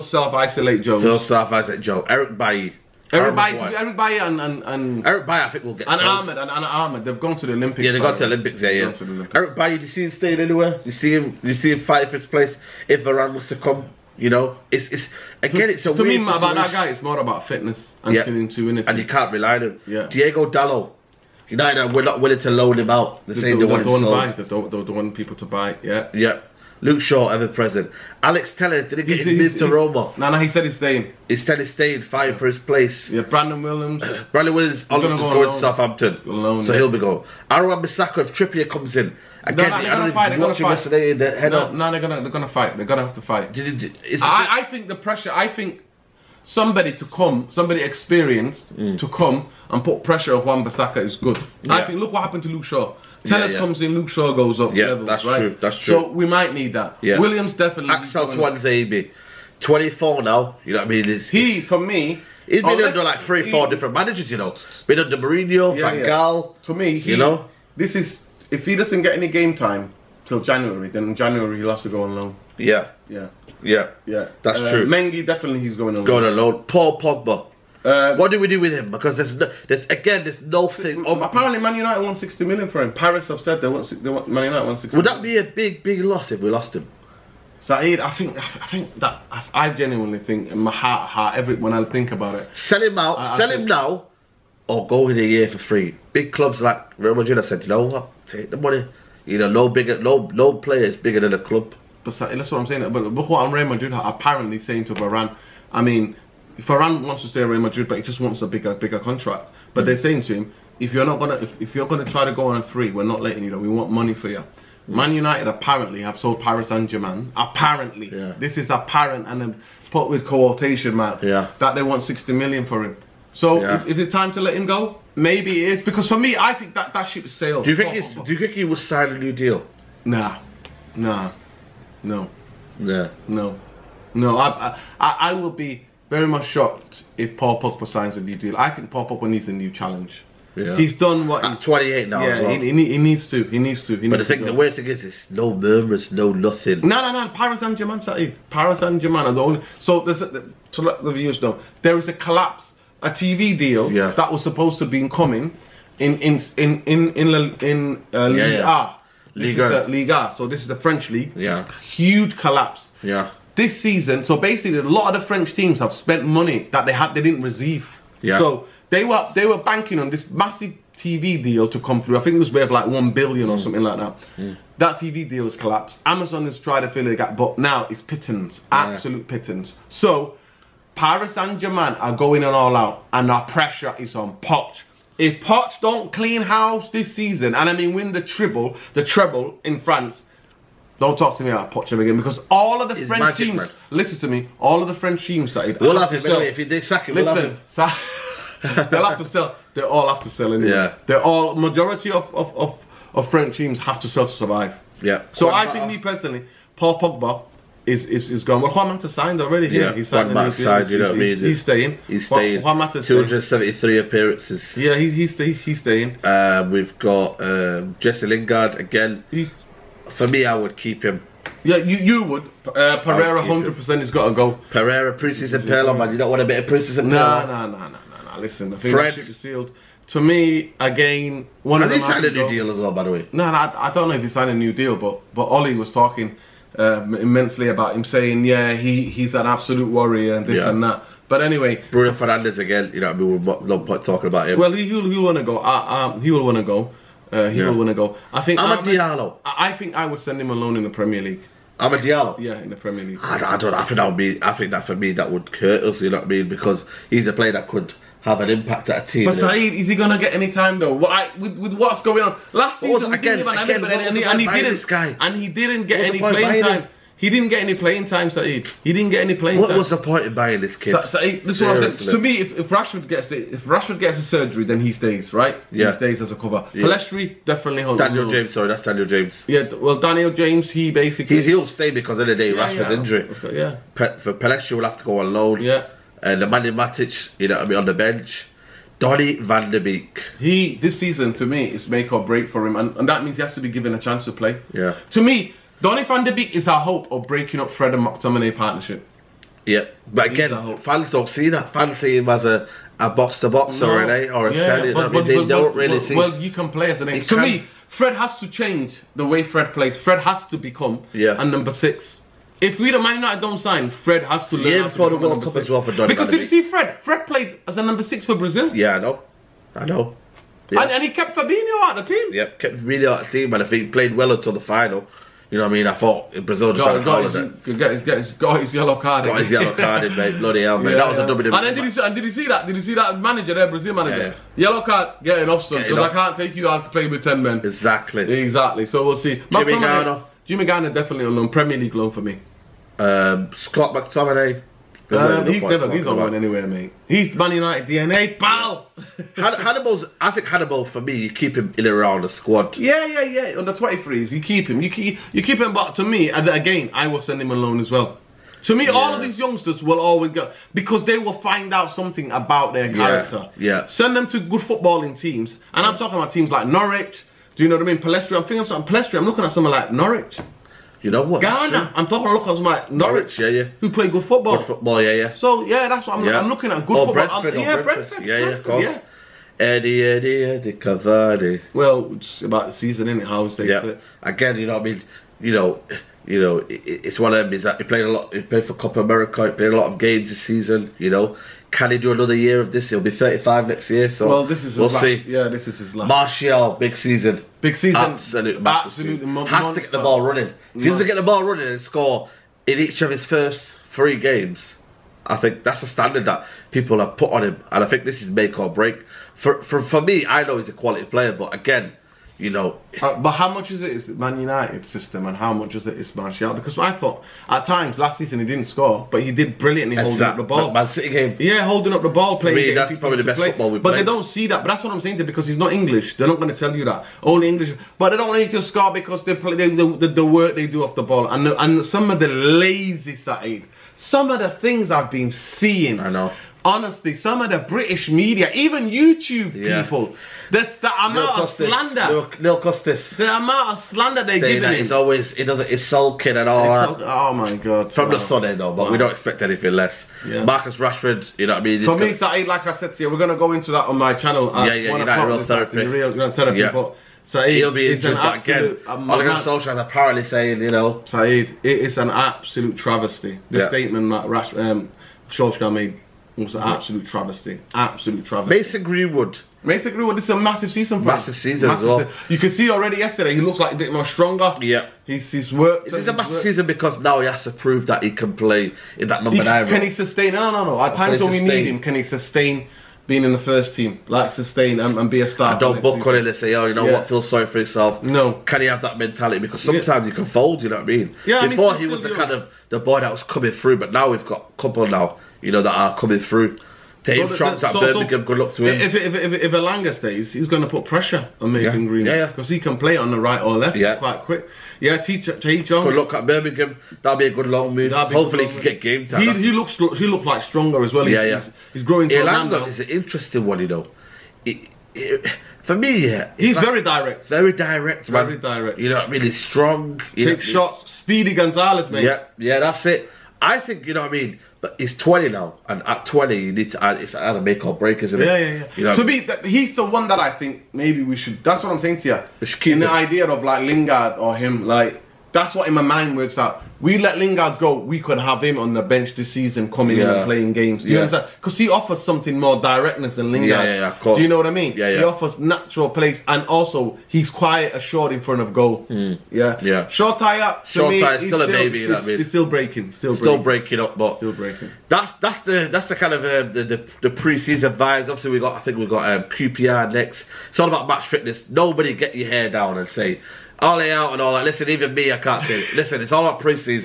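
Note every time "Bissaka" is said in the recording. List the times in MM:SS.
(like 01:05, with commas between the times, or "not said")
00:37, 00:50.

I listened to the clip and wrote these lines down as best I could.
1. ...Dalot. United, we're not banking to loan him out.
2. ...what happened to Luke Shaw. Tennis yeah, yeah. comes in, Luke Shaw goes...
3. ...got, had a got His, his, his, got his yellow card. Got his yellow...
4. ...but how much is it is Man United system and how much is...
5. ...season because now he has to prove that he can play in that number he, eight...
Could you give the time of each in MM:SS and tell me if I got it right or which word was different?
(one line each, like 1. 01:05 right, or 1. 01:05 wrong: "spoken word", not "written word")
1. 00:20 wrong: "willing", not "banking"
2. 00:52 right
3. 05:26 right
4. 06:53 right
5. 07:56 wrong: "nine", not "eight".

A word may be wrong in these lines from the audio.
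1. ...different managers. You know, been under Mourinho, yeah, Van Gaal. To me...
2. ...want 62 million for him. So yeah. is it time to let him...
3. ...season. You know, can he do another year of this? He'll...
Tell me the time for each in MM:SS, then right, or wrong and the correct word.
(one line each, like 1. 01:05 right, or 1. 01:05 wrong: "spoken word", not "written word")
1. 01:03 right
2. 02:01 wrong: "60", not "62"
3. 06:30 right.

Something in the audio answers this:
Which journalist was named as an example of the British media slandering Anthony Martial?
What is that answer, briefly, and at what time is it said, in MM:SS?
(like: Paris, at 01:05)
Neil Custis, at 07:22.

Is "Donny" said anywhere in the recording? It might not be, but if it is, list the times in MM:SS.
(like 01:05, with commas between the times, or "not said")
04:48, 04:55, 05:15.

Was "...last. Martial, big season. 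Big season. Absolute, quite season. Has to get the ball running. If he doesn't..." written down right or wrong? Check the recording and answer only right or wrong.
wrong.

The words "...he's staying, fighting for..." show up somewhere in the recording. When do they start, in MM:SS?
00:31.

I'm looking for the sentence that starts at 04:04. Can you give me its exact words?
Well, he, will he'll, he'll want to go.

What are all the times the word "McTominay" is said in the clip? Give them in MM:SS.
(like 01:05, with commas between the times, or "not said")
04:58, 05:43.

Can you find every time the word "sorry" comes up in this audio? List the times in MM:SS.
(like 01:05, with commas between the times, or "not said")
04:38, 08:07.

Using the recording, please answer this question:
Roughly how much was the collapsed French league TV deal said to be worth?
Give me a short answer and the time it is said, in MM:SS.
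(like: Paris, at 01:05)
1 billion, at 02:52.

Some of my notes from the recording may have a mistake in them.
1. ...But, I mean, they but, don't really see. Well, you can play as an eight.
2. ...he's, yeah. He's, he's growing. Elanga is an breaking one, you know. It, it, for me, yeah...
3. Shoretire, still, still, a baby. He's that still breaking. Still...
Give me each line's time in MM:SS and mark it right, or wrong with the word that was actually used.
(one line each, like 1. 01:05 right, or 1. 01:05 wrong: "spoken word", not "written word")
1. 05:04 right
2. 08:31 wrong: "interesting", not "breaking"
3. 09:10 right.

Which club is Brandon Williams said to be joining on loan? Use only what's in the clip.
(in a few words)
Southampton.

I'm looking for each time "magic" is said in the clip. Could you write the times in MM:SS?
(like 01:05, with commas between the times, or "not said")
03:13.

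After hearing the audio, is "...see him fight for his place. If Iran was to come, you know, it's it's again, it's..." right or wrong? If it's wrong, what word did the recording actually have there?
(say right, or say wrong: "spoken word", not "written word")
right.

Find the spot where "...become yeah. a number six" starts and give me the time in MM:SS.
05:10.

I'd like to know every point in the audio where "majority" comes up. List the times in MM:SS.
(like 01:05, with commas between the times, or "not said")
03:21.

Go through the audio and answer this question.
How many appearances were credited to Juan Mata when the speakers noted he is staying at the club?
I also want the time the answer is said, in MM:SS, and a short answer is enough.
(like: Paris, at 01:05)
273, at 03:33.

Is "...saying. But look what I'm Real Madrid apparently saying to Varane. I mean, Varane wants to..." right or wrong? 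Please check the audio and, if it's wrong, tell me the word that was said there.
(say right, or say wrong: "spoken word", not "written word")
right.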